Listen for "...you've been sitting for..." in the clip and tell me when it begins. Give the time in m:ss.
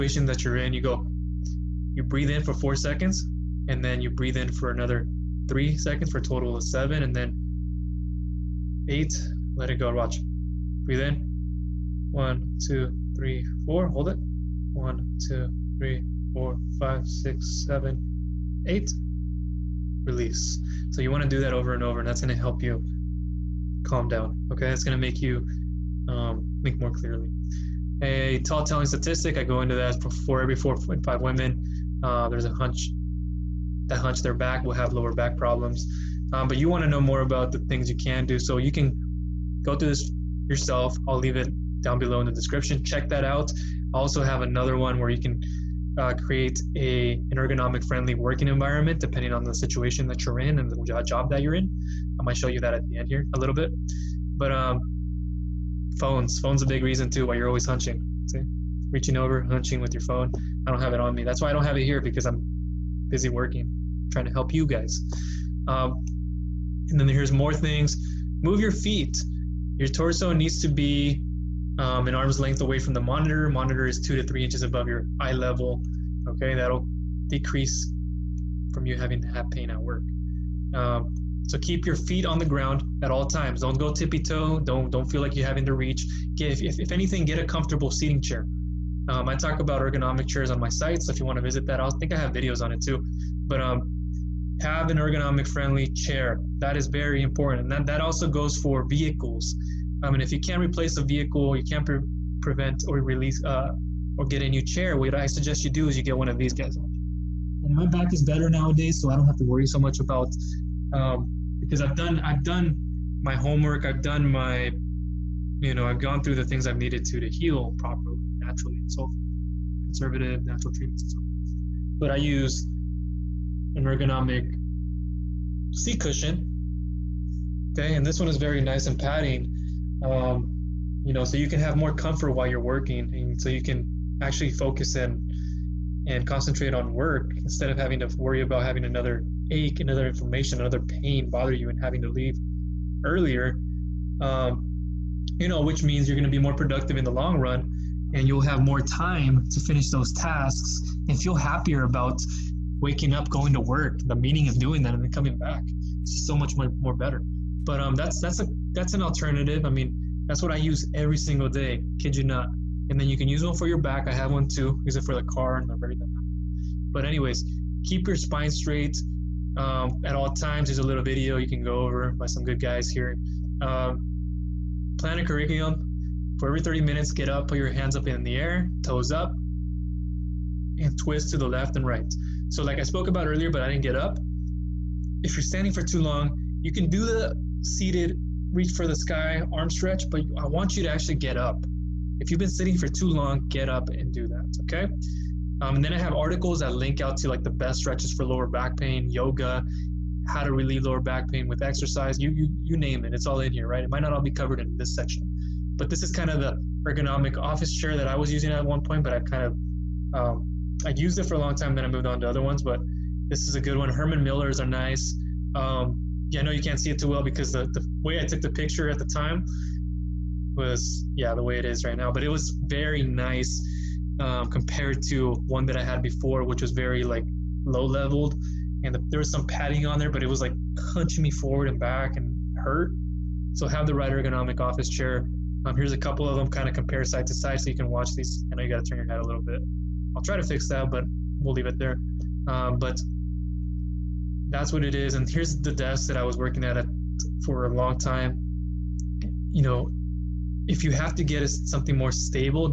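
3:12.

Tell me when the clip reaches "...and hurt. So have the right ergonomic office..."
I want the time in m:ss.
3:52.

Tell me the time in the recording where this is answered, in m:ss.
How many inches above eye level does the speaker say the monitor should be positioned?
1:14.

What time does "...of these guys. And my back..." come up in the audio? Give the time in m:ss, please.
1:46.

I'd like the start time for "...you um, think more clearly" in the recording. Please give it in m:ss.
0:25.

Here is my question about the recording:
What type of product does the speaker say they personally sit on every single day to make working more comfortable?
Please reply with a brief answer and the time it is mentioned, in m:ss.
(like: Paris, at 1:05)
ergonomic seat cushion, at 2:03.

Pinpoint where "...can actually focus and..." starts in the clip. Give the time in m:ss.
2:13.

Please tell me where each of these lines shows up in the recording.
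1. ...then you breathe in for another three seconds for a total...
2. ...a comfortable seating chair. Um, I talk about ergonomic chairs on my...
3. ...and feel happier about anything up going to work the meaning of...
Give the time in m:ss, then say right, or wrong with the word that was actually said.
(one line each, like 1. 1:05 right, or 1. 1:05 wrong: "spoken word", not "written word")
1. 0:03 right
2. 1:27 right
3. 2:31 wrong: "waking", not "anything".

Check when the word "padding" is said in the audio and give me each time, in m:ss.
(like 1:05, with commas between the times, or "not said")
2:08, 3:49.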